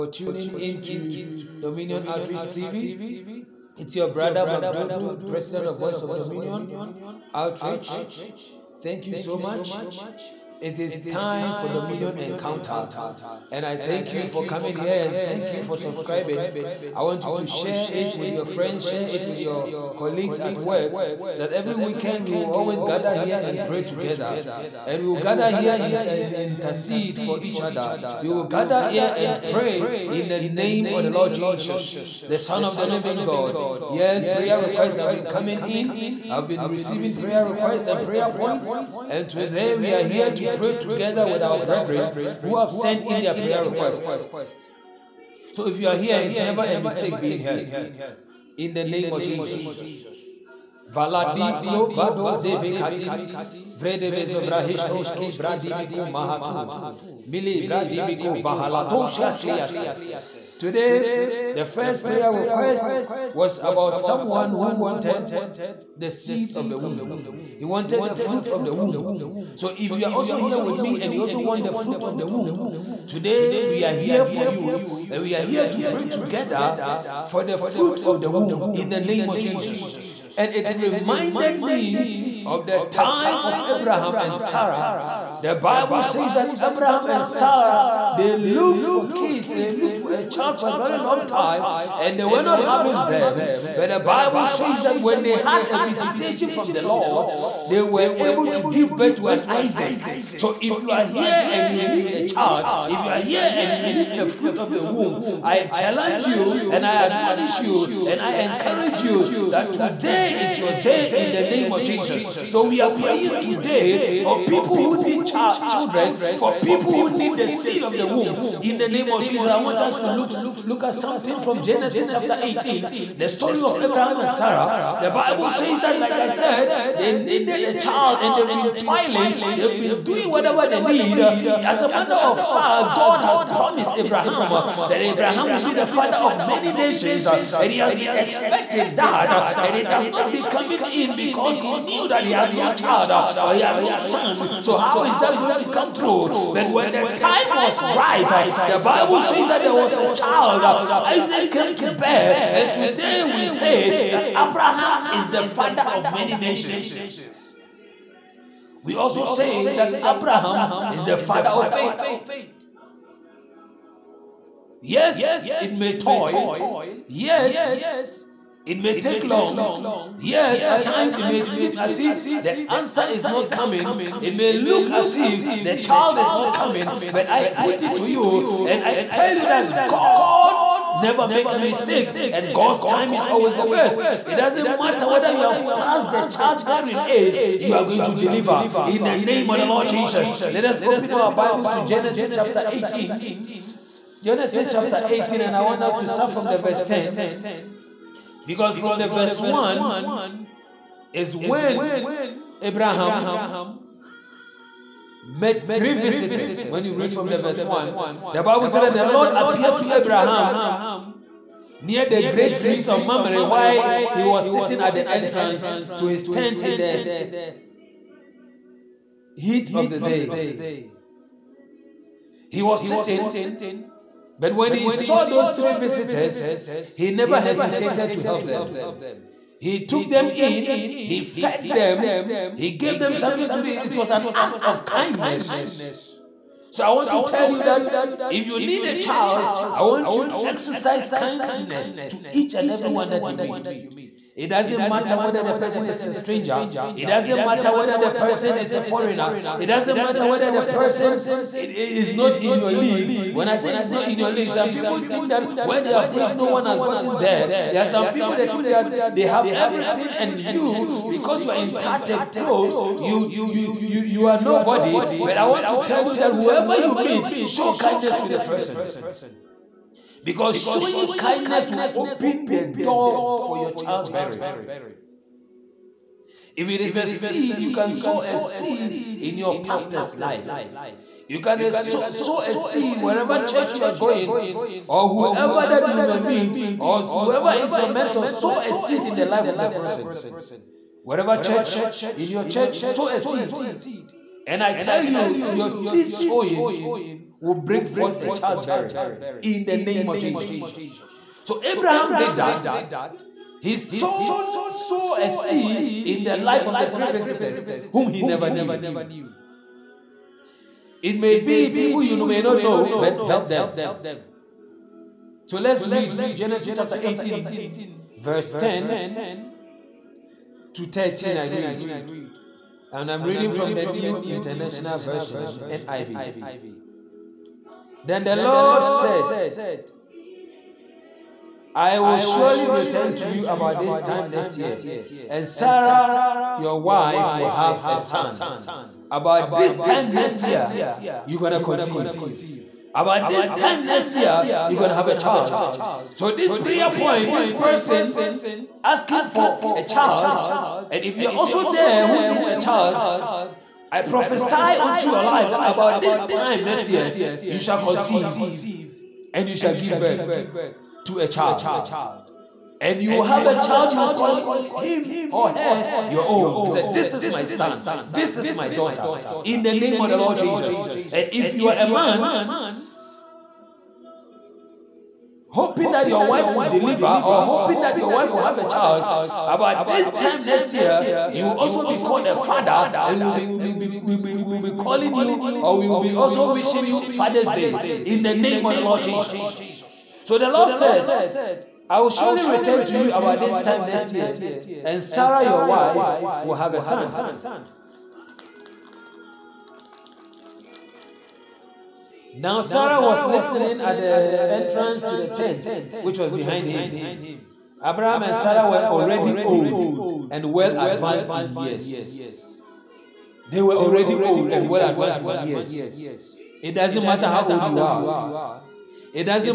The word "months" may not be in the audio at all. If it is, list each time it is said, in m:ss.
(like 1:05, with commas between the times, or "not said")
not said.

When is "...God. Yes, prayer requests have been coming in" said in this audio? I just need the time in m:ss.
0:33.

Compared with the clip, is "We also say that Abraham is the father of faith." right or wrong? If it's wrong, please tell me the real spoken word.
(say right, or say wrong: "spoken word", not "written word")
right.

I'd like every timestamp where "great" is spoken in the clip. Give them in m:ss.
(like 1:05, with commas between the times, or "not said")
3:32.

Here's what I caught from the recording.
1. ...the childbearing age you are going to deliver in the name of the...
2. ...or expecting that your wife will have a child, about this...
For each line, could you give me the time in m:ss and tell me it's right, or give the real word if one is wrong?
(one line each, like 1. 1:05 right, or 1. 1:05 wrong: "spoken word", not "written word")
1. 3:06 right
2. 6:17 wrong: "hoping", not "expecting".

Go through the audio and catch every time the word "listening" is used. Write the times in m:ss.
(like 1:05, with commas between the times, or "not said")
6:43.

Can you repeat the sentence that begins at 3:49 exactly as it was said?
He took them in he fed them, he gave them something to eat.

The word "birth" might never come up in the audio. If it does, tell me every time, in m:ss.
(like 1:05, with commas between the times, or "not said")
1:38, 5:59.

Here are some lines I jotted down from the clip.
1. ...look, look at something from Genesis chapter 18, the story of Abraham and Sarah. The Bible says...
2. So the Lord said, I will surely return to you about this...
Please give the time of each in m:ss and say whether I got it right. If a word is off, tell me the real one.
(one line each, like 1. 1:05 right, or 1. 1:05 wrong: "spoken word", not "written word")
1. 2:00 right
2. 6:30 right.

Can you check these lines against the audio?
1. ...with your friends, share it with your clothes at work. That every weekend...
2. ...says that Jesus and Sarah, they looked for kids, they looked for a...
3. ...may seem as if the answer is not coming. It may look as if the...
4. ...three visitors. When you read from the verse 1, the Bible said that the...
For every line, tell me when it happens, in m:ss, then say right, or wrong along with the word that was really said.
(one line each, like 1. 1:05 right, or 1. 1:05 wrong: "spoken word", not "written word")
1. 0:18 wrong: "colleagues", not "clothes"
2. 1:26 wrong: "Abraham", not "Jesus"
3. 2:51 right
4. 3:25 right.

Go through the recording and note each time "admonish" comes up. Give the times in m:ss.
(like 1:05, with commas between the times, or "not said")
1:47.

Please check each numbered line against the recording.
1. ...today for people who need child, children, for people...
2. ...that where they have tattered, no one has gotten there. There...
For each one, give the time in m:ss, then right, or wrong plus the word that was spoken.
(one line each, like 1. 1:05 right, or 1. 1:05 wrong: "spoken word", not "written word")
1. 1:53 right
2. 4:15 wrong: "reached", not "tattered".